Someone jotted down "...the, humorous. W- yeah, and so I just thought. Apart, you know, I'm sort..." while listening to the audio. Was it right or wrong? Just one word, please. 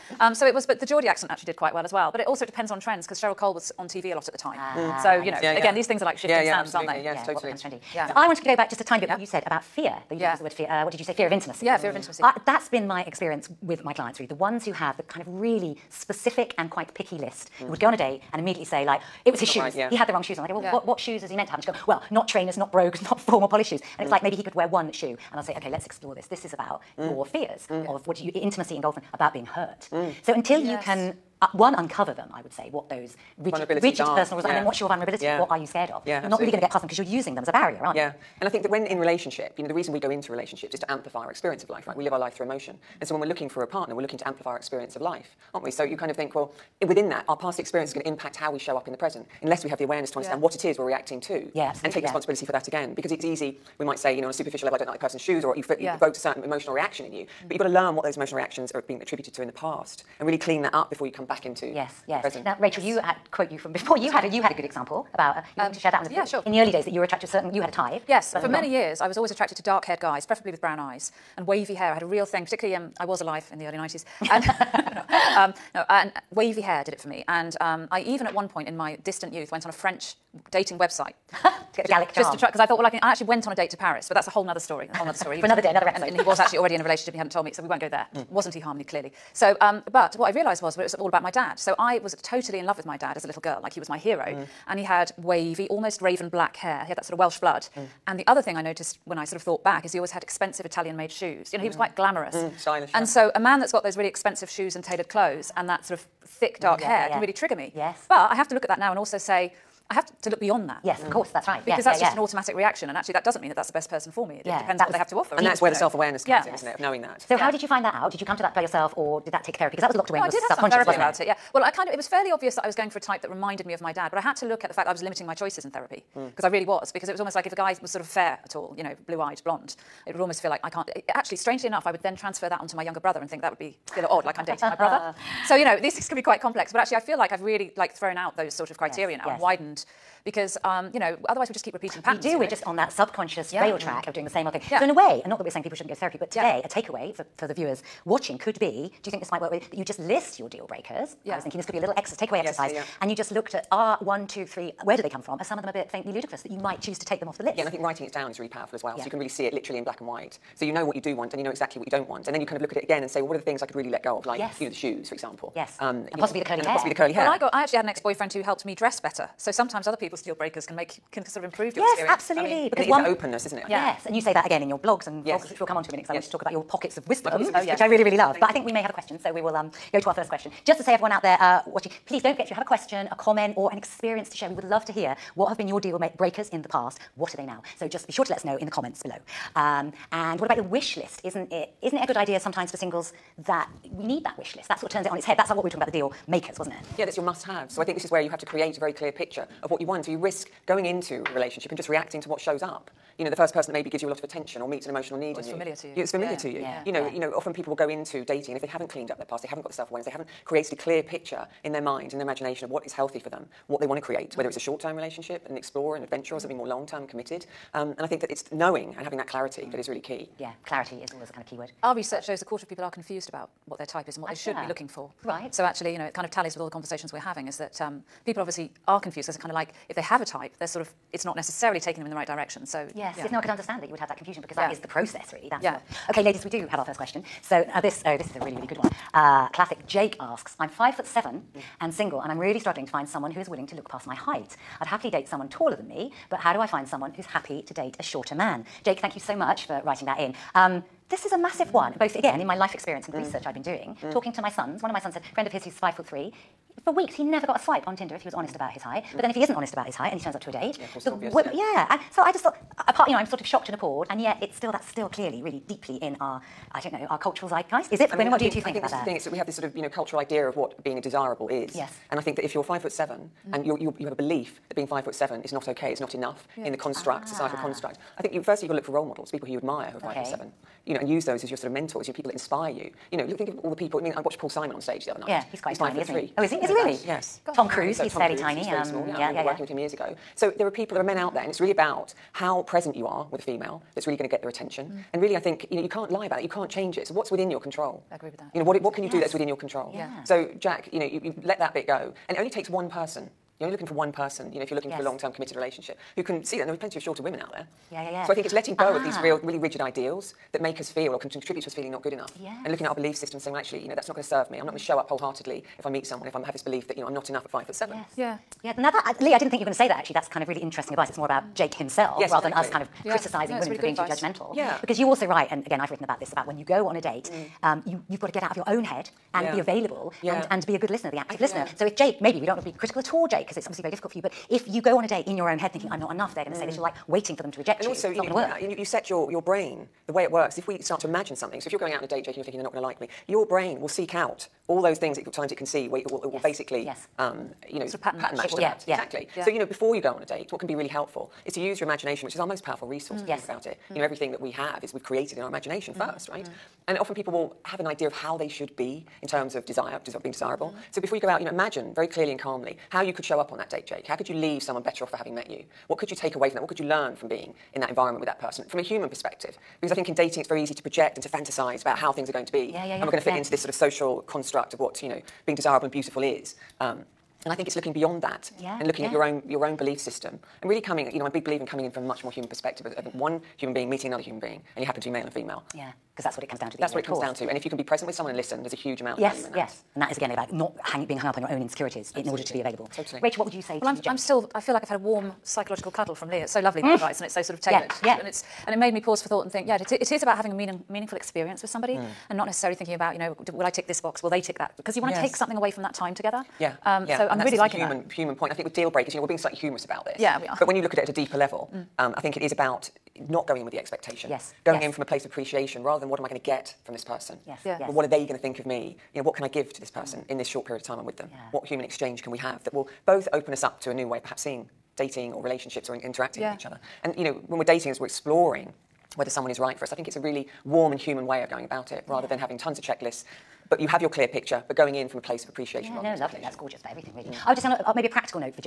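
wrong.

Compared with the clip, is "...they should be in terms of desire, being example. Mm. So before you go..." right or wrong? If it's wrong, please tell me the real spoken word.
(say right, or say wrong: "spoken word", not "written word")
wrong: "desirable", not "example".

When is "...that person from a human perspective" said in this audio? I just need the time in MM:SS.
06:08.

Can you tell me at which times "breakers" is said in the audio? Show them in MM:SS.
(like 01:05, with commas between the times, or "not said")
02:30, 02:50, 03:06, 06:48.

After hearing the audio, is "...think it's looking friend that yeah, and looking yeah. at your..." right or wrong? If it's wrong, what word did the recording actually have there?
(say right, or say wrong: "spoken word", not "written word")
wrong: "beyond", not "friend".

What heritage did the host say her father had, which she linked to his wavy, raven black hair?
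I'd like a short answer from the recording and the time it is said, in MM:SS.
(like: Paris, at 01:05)
Welsh, at 01:37.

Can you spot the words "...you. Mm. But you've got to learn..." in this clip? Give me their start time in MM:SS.
00:57.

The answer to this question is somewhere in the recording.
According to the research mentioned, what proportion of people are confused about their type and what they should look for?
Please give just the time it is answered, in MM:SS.
03:42.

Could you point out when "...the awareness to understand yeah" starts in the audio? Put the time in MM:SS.
00:49.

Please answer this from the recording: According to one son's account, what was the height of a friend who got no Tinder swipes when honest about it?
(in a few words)
5 foot 3.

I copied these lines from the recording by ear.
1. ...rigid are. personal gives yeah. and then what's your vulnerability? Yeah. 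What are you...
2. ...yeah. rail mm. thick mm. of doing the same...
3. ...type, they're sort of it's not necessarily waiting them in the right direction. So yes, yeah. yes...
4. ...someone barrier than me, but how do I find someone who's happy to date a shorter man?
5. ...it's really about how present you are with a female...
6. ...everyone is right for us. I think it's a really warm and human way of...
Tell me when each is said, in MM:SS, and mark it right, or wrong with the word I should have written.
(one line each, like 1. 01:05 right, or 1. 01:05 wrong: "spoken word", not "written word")
1. 00:33 wrong: "rules", not "gives"
2. 02:23 wrong: "track", not "thick"
3. 03:50 wrong: "taking", not "waiting"
4. 04:05 wrong: "taller", not "barrier"
5. 04:51 right
6. 07:09 wrong: "someone", not "everyone".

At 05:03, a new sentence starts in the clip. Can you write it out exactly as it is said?
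You're only looking for one person, you know, if you're looking yes.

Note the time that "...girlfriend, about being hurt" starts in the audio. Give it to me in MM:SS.
00:28.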